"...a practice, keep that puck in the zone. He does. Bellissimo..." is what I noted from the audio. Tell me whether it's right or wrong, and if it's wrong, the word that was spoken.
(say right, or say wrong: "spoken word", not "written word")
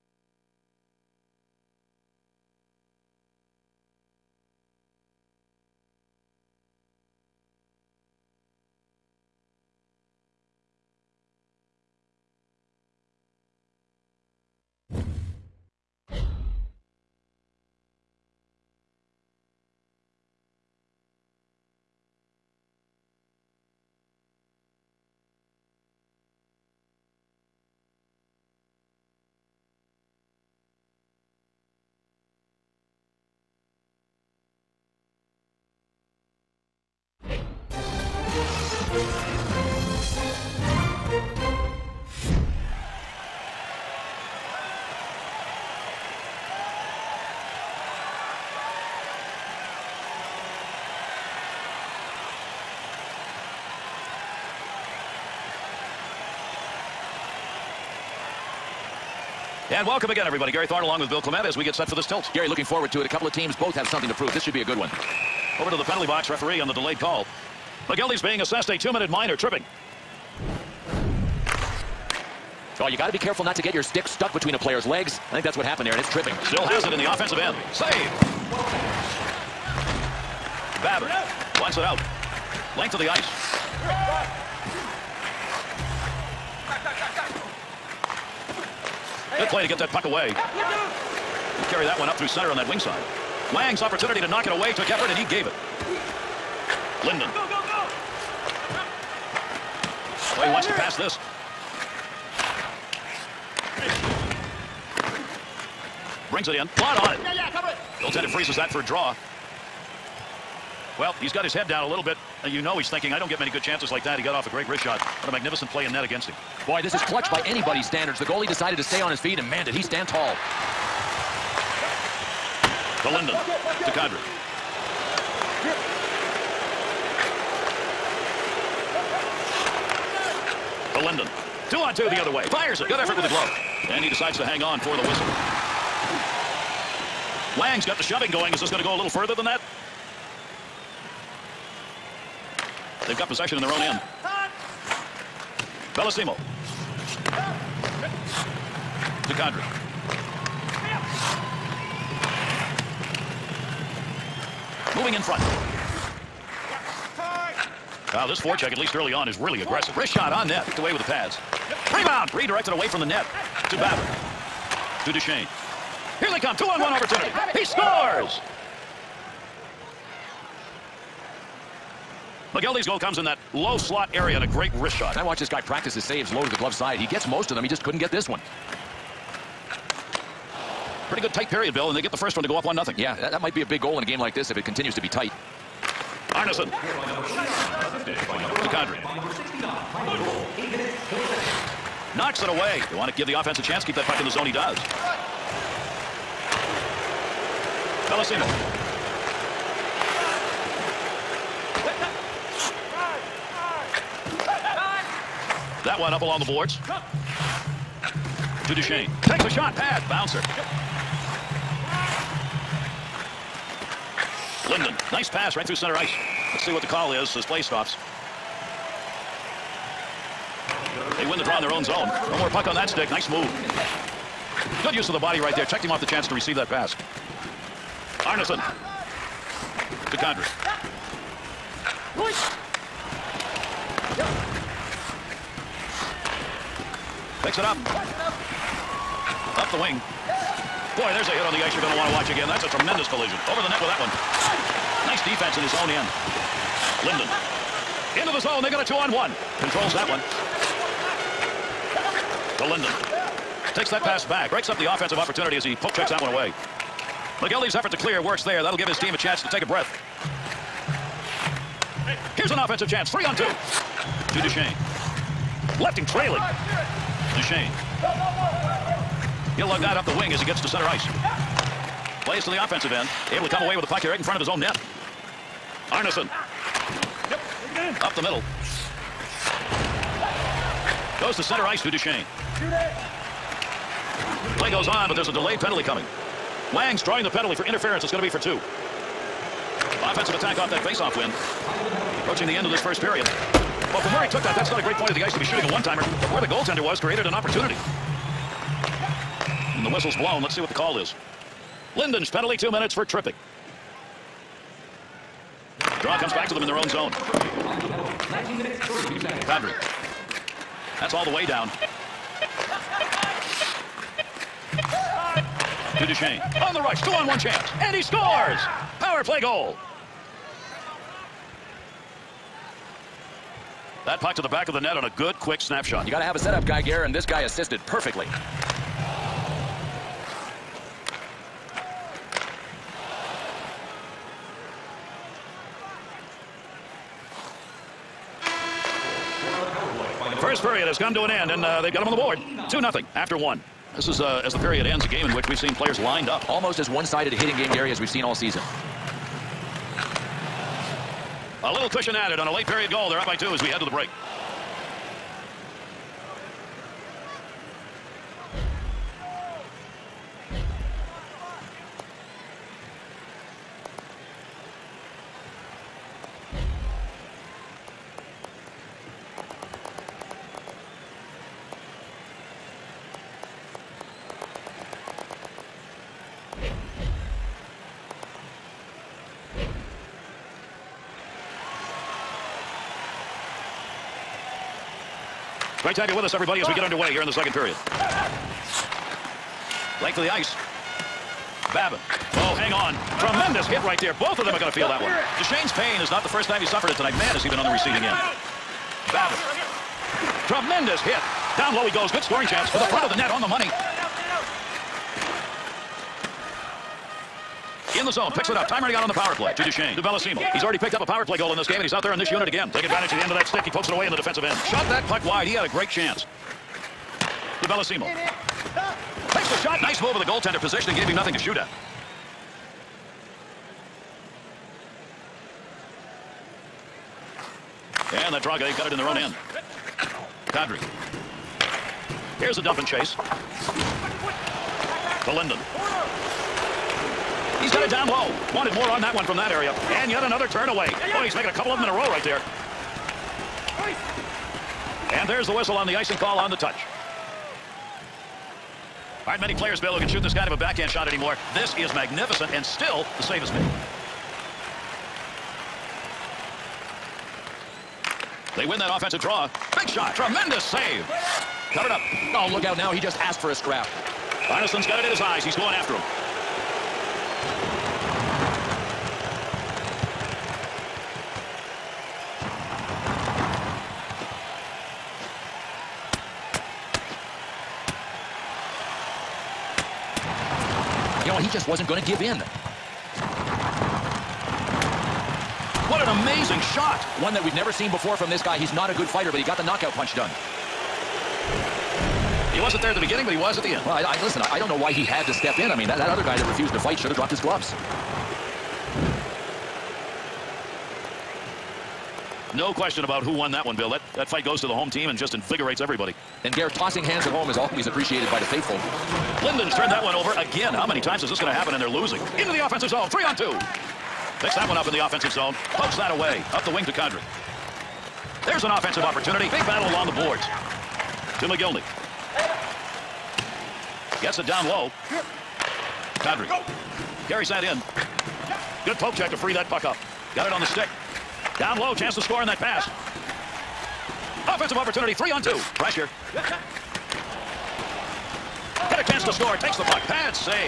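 wrong: "chance", not "practice".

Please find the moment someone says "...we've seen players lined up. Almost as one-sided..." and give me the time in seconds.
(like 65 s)
345 s.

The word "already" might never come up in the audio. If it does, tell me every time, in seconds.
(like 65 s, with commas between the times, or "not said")
410 s.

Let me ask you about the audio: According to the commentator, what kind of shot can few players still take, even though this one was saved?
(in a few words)
Backhand.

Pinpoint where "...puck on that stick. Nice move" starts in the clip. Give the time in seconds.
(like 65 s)
222 s.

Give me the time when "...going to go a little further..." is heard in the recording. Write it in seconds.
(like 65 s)
138 s.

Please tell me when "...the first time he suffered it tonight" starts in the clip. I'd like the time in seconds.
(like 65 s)
396 s.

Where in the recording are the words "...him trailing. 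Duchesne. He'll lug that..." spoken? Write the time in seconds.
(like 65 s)
265 s.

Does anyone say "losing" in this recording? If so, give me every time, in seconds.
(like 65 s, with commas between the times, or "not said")
511 s.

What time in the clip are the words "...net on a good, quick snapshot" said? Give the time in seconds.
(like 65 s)
324 s.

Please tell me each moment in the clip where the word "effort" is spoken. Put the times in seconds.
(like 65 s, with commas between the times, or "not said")
94 s, 132 s, 257 s.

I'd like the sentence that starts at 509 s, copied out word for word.
Linden's turned that one over again.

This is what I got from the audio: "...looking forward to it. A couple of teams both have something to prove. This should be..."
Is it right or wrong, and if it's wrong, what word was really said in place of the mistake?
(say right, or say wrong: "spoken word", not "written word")
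right.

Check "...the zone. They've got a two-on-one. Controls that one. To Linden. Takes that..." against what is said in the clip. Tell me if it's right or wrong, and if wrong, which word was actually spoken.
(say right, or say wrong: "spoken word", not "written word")
right.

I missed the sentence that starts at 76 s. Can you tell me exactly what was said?
Still has it in the offensive end.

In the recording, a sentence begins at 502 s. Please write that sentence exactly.
no question about who won that one, Bill.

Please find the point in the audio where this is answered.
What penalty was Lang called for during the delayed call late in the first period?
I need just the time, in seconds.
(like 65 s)
287 s.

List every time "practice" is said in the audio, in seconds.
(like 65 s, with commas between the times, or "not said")
175 s.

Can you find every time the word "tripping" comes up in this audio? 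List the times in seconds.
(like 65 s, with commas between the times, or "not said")
69 s, 76 s, 303 s.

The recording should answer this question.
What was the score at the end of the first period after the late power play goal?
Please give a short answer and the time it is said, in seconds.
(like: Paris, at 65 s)
2-0, at 342 s.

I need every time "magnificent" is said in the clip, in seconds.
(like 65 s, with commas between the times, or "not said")
115 s, 451 s.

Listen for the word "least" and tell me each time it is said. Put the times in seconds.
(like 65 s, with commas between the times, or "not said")
158 s.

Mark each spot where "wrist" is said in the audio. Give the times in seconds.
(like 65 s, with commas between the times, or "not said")
114 s, 159 s, 174 s.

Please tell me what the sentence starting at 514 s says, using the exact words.
Picks that one up in the offensive zone.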